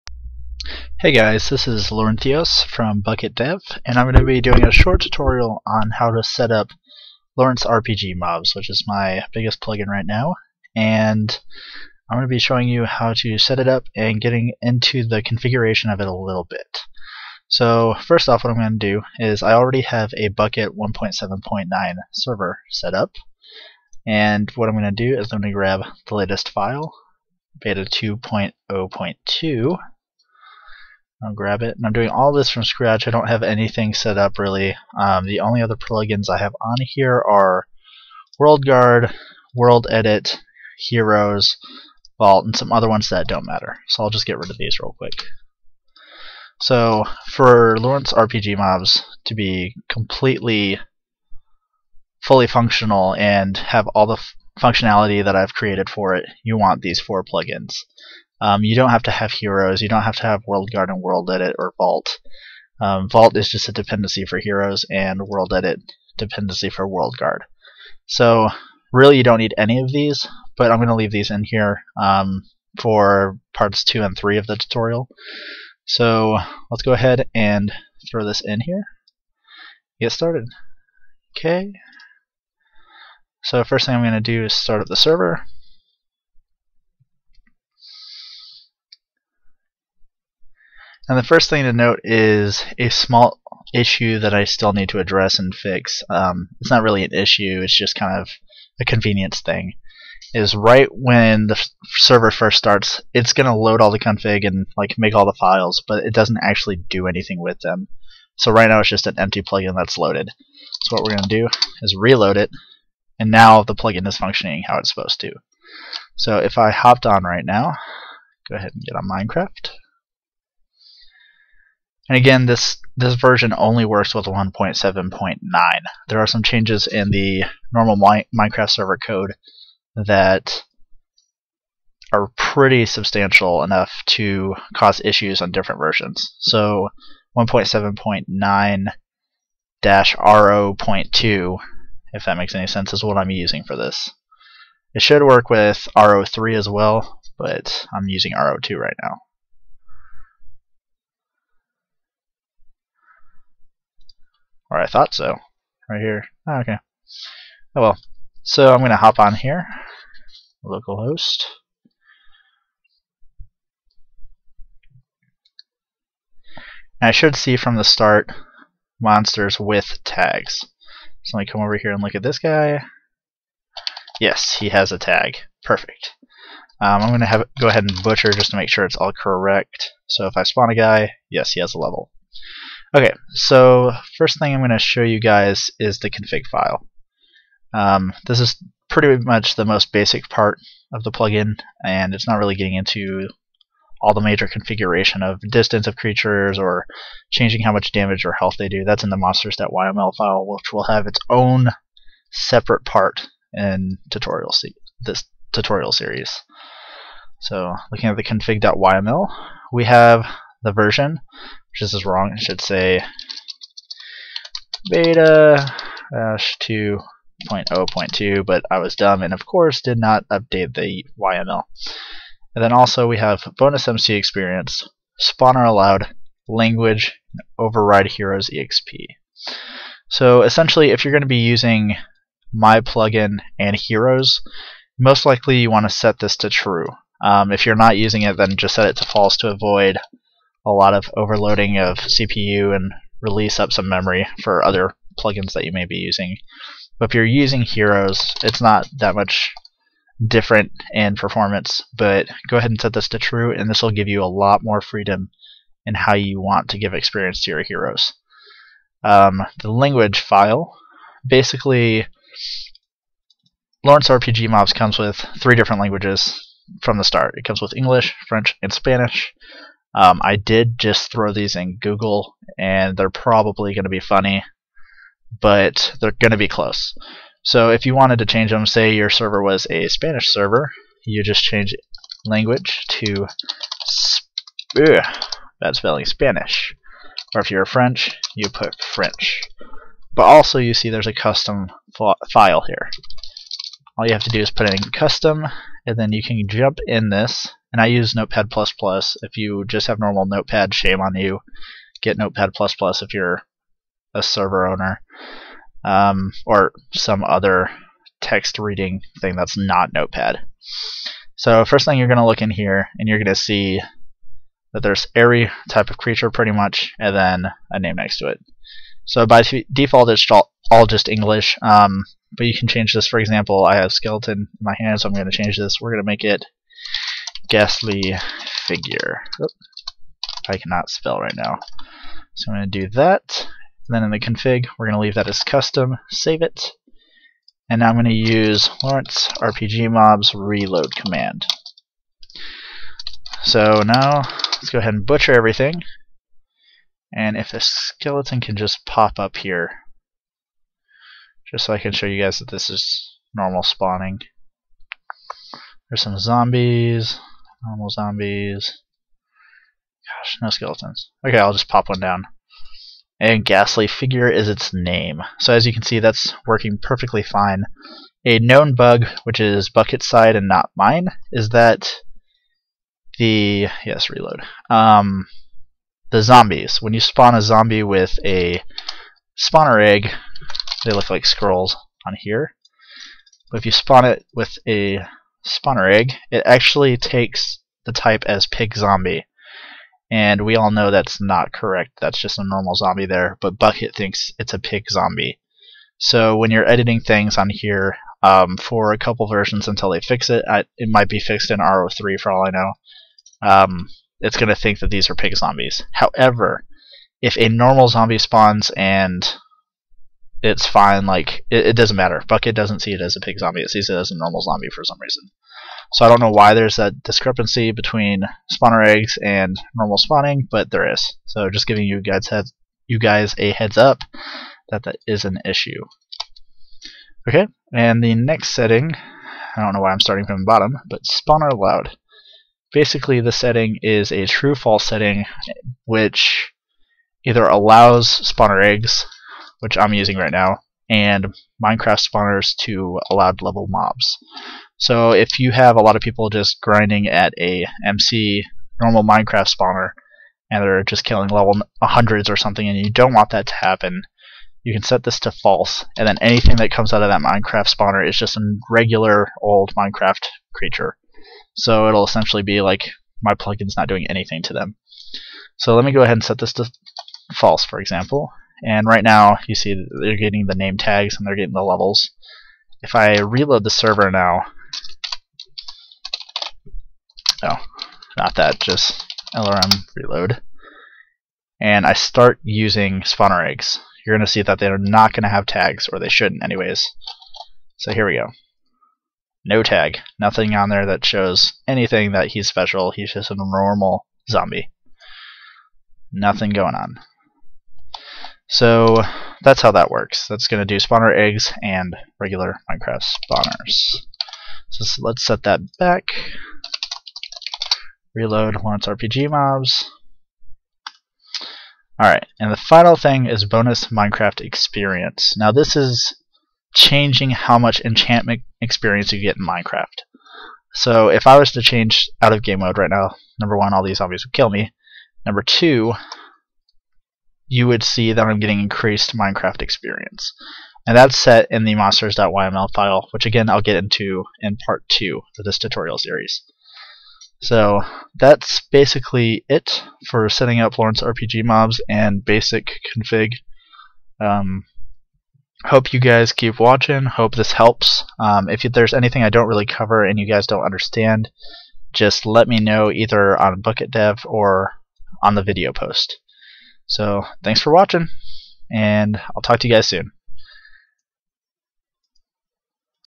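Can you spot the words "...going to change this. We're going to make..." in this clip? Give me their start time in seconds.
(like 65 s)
325 s.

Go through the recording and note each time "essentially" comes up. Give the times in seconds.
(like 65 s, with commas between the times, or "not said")
230 s, 462 s.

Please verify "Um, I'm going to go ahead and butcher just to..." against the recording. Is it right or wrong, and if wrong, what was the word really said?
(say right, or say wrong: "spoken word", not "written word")
right.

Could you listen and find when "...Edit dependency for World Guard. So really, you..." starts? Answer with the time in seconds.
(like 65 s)
65 s.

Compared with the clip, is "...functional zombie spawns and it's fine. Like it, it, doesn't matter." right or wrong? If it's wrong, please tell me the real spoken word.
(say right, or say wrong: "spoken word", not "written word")
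wrong: "normal", not "functional".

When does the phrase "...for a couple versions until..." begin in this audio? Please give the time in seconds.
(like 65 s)
398 s.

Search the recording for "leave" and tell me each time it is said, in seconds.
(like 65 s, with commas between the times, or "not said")
70 s, 335 s.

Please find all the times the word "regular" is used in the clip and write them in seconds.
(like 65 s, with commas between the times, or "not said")
458 s, 502 s.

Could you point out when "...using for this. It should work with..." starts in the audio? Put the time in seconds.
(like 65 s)
143 s.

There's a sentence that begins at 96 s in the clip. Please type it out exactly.
Um, it's not really an issue, it's just kind of a convenience thing.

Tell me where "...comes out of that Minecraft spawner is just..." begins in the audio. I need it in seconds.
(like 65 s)
456 s.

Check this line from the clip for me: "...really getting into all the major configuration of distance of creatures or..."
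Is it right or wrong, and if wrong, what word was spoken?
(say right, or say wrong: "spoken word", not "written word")
right.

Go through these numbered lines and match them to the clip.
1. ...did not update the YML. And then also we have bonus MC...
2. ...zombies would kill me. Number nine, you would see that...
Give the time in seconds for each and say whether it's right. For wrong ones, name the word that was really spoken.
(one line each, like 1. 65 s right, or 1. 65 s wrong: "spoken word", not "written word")
1. 219 s right
2. 523 s wrong: "two", not "nine".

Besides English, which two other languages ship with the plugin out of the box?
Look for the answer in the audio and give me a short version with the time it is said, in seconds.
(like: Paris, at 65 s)
French and Spanish, at 268 s.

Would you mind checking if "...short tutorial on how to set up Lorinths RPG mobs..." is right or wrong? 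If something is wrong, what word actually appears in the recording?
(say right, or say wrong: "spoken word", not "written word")
right.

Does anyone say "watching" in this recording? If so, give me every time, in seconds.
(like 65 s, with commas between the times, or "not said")
546 s, 557 s.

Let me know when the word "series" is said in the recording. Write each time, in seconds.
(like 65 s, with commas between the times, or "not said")
205 s, 535 s.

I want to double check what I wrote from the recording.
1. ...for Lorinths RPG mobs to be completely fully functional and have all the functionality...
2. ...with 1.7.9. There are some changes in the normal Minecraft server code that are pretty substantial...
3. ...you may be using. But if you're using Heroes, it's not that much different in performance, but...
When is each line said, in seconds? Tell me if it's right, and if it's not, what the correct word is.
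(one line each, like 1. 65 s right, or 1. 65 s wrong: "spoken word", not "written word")
1. 47 s right
2. 124 s right
3. 245 s right.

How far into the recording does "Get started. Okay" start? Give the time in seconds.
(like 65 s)
79 s.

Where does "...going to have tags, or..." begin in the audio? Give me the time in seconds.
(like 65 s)
485 s.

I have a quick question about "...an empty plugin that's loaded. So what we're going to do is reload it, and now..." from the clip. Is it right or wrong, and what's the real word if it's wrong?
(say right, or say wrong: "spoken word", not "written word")
right.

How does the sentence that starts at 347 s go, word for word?
And if the skeleton can just pop up here, just so I can show you guys that this is normal spawning.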